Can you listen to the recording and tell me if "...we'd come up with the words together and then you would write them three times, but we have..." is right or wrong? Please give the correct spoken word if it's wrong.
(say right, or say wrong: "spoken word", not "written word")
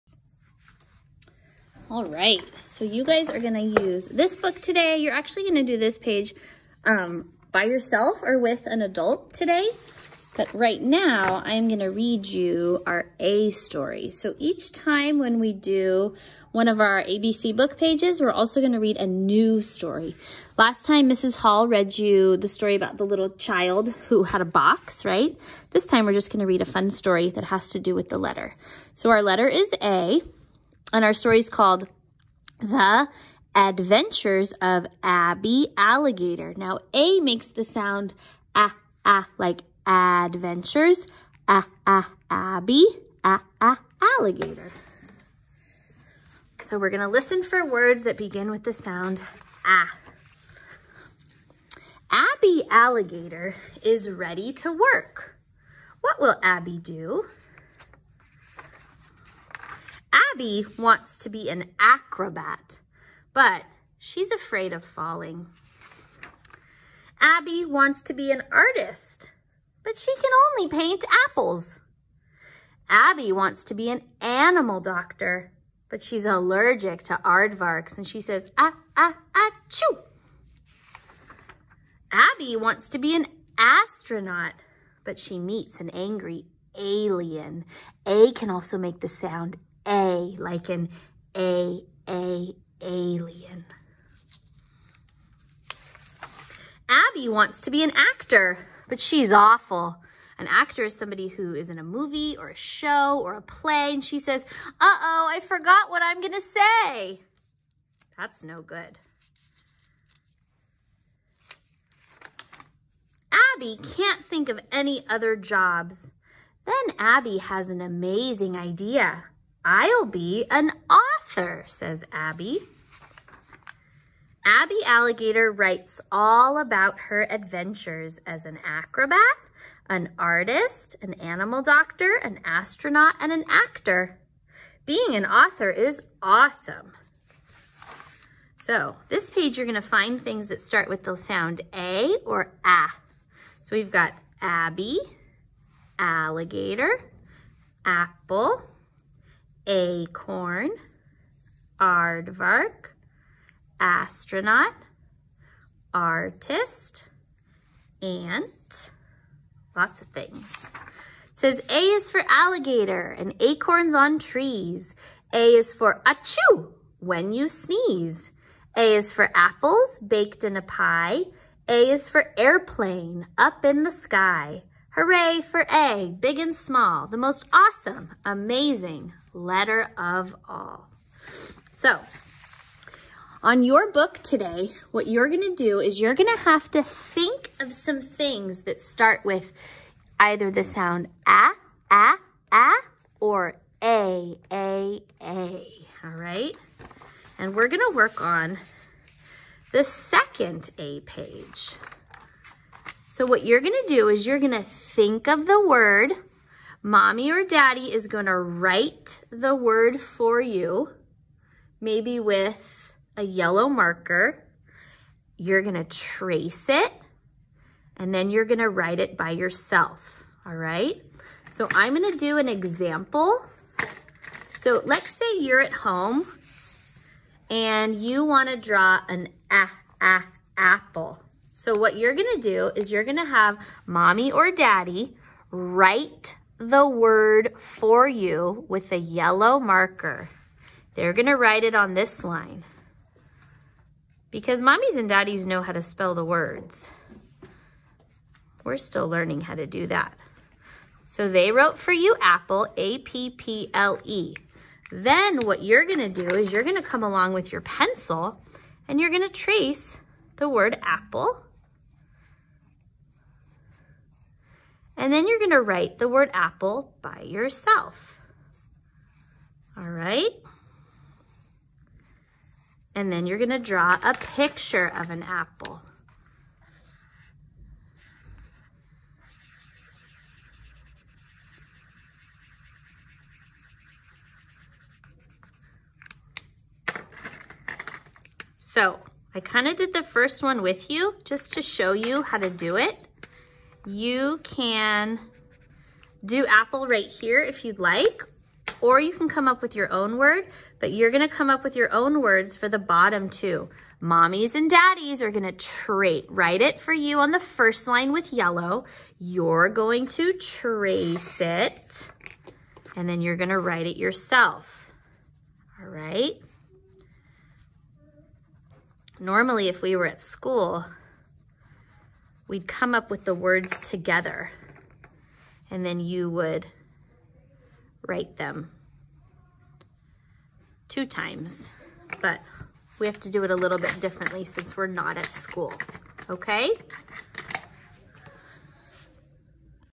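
wrong: "two", not "three".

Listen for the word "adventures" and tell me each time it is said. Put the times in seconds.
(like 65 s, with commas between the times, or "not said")
33 s, 39 s, 127 s.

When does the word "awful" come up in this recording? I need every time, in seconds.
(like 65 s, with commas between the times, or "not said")
99 s.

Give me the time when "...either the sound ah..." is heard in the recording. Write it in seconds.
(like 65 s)
190 s.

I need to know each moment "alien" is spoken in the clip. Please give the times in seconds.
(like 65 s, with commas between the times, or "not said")
86 s, 92 s.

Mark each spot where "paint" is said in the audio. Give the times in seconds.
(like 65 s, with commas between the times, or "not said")
70 s.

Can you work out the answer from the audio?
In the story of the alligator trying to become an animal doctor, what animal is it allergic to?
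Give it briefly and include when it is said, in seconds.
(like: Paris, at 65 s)
Aardvarks, at 77 s.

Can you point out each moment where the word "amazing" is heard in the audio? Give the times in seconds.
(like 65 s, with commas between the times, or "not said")
117 s, 178 s.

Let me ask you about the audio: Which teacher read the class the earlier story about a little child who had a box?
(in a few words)
Mrs. Hall.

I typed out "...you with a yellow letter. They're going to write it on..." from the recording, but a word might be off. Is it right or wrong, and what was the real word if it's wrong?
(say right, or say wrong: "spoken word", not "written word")
wrong: "marker", not "letter".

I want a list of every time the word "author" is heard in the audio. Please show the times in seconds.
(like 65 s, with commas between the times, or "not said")
120 s, 135 s.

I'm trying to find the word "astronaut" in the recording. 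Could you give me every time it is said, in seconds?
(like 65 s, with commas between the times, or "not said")
83 s, 132 s, 153 s.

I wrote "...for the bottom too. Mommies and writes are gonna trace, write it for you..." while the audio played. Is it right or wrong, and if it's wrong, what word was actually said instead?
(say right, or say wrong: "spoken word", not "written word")
wrong: "daddies", not "writes".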